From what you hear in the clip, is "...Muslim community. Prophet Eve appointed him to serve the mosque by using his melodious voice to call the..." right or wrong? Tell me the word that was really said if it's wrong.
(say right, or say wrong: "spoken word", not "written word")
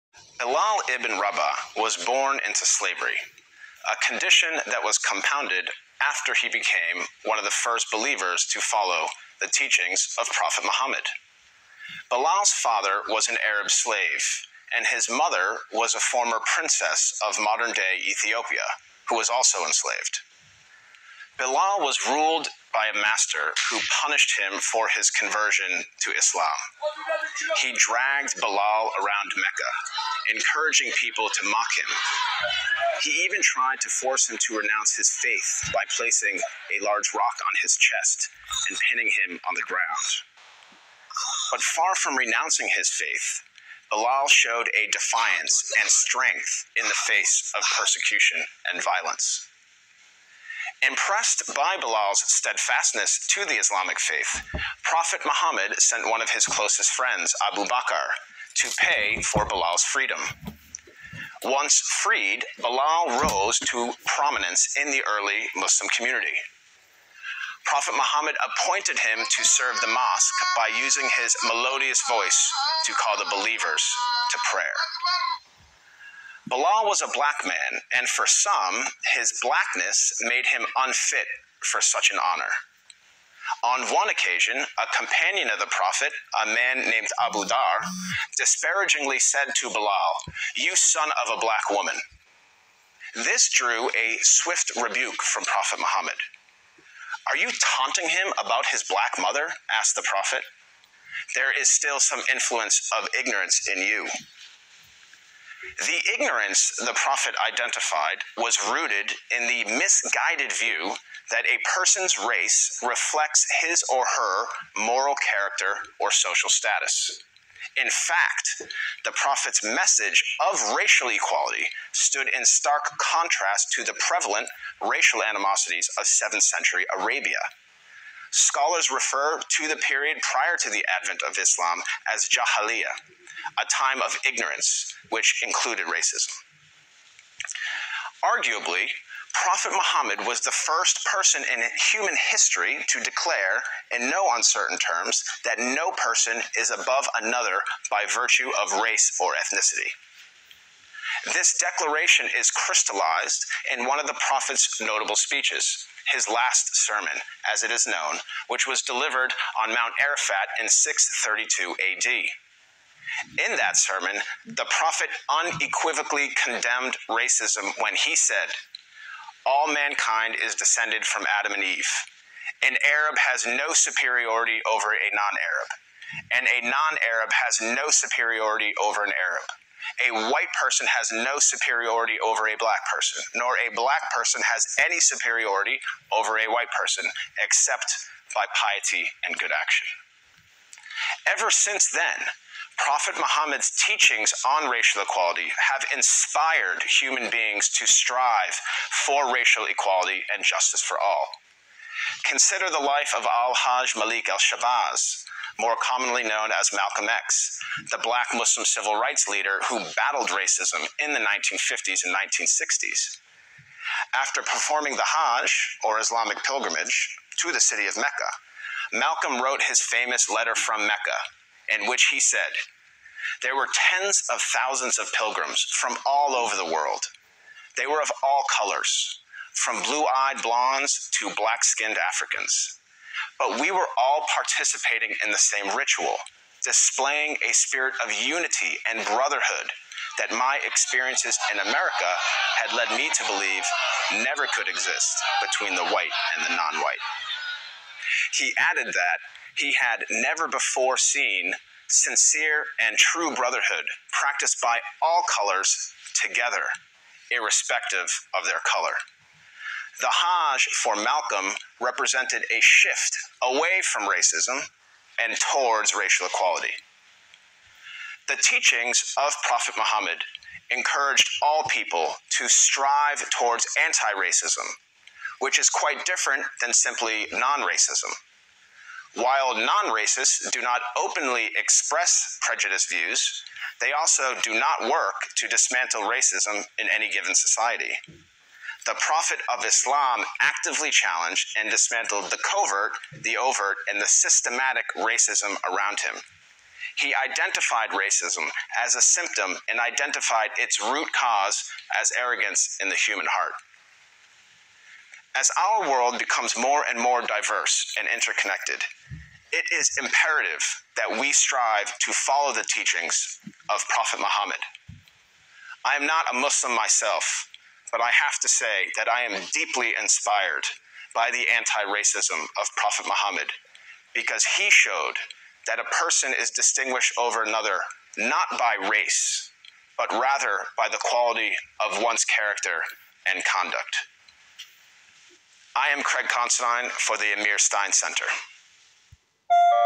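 wrong: "Muhammad", not "Eve".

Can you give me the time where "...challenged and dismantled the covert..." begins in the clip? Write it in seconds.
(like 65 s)
290 s.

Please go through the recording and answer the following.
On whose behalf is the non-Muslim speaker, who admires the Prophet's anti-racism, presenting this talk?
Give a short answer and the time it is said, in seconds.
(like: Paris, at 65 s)
Amir Stein Center, at 337 s.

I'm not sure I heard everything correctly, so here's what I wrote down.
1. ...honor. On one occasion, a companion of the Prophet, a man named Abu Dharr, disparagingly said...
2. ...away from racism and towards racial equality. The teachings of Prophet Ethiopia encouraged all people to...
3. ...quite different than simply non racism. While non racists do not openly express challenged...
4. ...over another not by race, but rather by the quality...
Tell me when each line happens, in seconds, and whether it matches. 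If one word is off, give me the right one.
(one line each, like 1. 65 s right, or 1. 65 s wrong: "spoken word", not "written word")
1. 82 s right
2. 263 s wrong: "Muhammad", not "Ethiopia"
3. 275 s wrong: "prejudiced", not "challenged"
4. 327 s right.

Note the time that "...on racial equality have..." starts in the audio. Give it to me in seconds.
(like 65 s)
194 s.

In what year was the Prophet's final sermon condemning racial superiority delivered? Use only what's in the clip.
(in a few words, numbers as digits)
632 AD.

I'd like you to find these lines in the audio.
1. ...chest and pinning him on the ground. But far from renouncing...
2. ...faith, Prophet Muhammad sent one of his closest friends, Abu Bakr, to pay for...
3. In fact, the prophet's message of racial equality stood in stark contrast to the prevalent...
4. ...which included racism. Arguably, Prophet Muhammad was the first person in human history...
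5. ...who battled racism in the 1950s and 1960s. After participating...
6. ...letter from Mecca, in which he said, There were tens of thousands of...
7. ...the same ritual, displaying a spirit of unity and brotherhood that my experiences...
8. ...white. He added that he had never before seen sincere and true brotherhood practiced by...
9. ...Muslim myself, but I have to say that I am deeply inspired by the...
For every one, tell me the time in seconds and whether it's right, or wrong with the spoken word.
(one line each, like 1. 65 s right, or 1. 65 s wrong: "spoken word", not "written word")
1. 37 s right
2. 53 s right
3. 117 s right
4. 135 s right
5. 209 s wrong: "performing", not "participating"
6. 220 s right
7. 235 s right
8. 246 s right
9. 316 s right.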